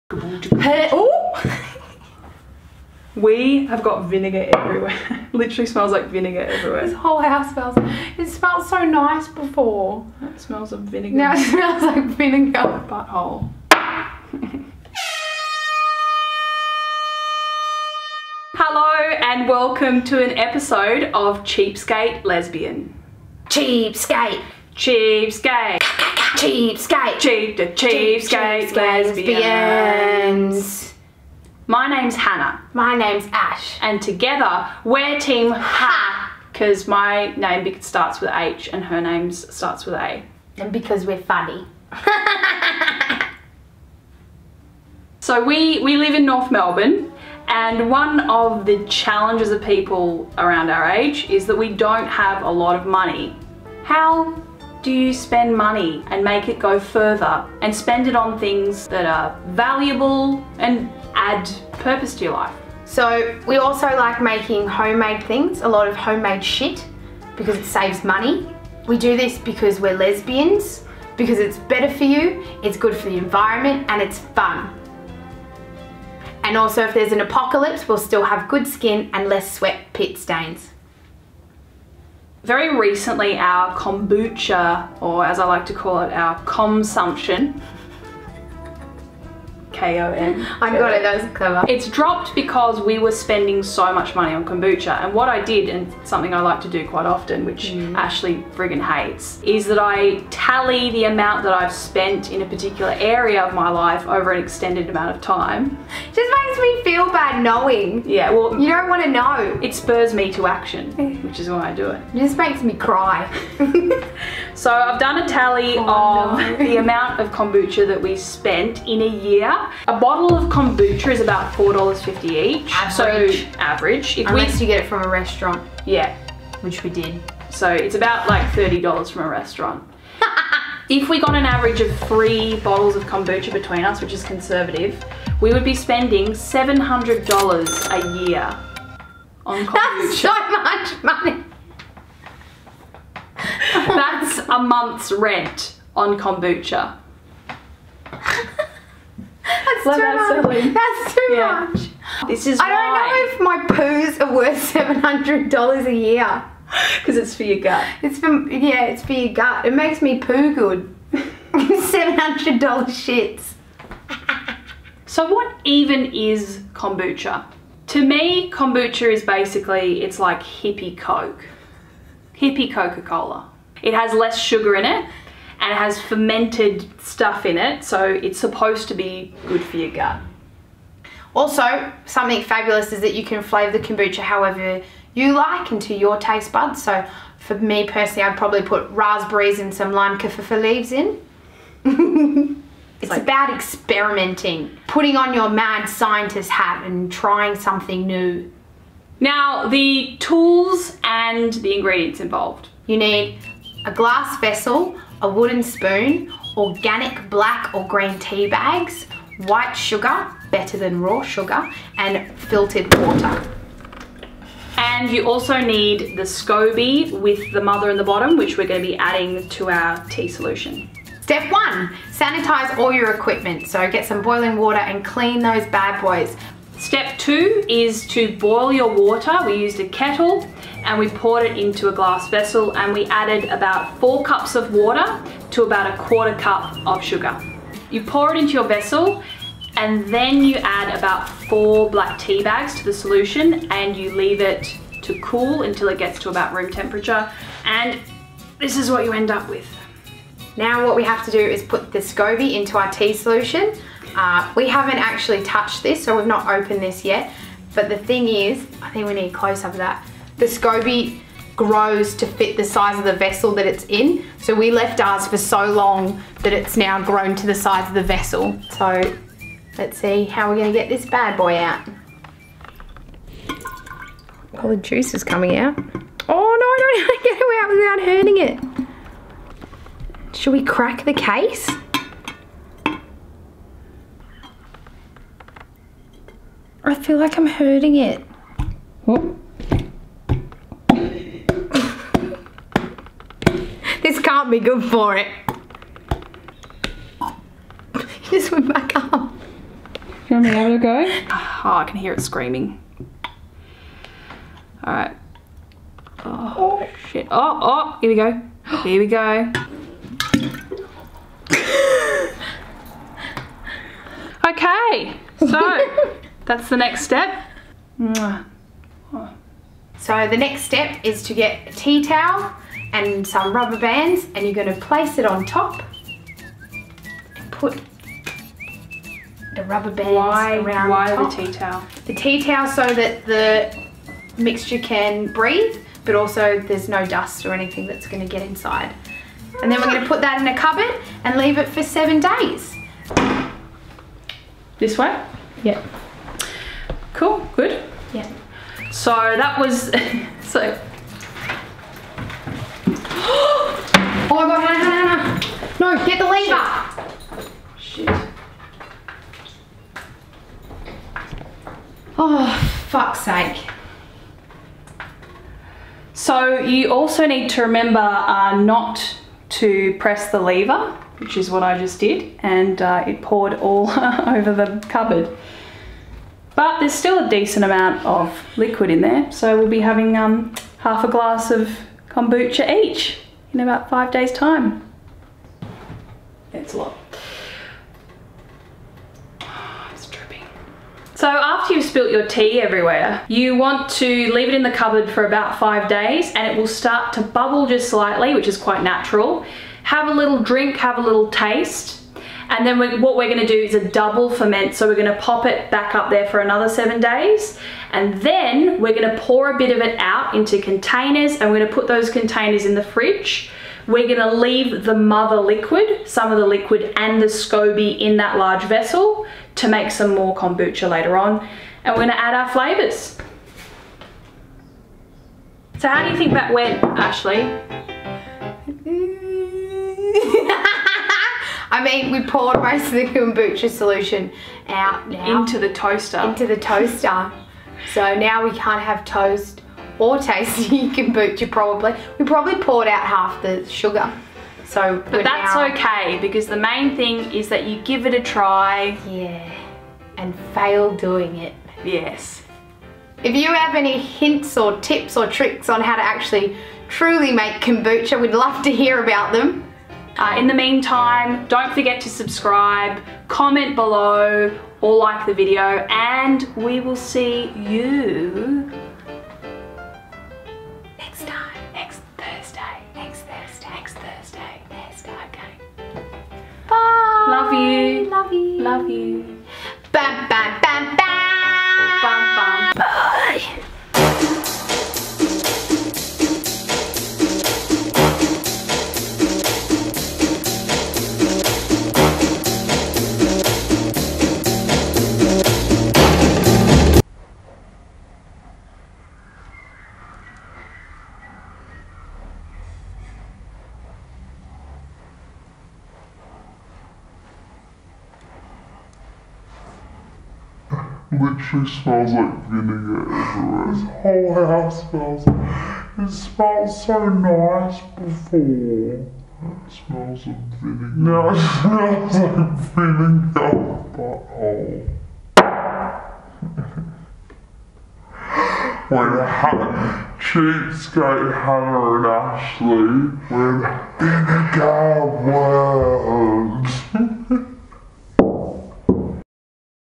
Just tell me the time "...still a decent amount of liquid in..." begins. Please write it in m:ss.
6:16.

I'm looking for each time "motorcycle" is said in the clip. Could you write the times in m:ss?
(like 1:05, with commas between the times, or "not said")
not said.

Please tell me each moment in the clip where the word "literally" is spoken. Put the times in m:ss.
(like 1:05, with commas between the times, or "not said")
0:05, 8:31.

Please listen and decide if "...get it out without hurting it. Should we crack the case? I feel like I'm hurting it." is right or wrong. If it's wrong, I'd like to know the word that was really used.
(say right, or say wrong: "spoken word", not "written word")
right.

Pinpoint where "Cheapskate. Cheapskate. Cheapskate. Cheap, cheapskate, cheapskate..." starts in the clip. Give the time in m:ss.
0:23.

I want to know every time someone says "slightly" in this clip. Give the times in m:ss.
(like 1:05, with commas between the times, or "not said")
6:37.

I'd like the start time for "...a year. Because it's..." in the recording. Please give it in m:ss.
2:35.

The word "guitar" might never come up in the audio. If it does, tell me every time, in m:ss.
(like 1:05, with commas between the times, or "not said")
not said.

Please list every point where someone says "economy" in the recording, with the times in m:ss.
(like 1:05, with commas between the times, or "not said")
not said.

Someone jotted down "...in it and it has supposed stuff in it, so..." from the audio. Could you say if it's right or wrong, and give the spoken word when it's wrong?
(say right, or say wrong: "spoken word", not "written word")
wrong: "fermented", not "supposed".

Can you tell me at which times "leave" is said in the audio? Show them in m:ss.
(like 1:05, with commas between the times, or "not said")
3:10, 4:04, 5:41, 6:34, 6:54.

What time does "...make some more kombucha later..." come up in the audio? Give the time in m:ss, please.
6:59.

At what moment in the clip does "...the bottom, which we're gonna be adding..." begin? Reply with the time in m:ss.
3:37.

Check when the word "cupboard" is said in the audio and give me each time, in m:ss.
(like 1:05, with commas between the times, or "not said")
5:40, 6:14, 6:34.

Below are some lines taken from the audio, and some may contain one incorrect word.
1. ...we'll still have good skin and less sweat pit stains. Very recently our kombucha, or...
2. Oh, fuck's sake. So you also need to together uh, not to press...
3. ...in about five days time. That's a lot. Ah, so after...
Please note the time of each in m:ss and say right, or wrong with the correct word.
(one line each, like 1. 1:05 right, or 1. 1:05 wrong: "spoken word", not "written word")
1. 1:17 right
2. 6:02 wrong: "remember", not "together"
3. 6:23 right.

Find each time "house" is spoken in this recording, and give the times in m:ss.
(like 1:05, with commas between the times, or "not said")
0:07, 8:34.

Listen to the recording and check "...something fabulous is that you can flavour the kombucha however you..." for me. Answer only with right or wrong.
right.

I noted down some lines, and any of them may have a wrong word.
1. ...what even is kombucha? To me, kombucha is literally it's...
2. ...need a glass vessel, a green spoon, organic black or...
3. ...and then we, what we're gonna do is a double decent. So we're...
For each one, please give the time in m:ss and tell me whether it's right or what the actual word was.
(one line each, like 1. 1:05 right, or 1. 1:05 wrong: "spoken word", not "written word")
1. 2:45 wrong: "basically", not "literally"
2. 3:22 wrong: "wooden", not "green"
3. 6:42 wrong: "ferment", not "decent".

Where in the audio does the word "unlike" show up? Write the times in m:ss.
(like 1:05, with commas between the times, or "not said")
not said.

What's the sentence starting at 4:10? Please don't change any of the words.
Now what we have to do is put the SCOBY into our tea solution.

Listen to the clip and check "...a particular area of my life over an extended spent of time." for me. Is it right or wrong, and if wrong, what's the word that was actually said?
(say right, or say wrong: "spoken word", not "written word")
wrong: "amount", not "spent".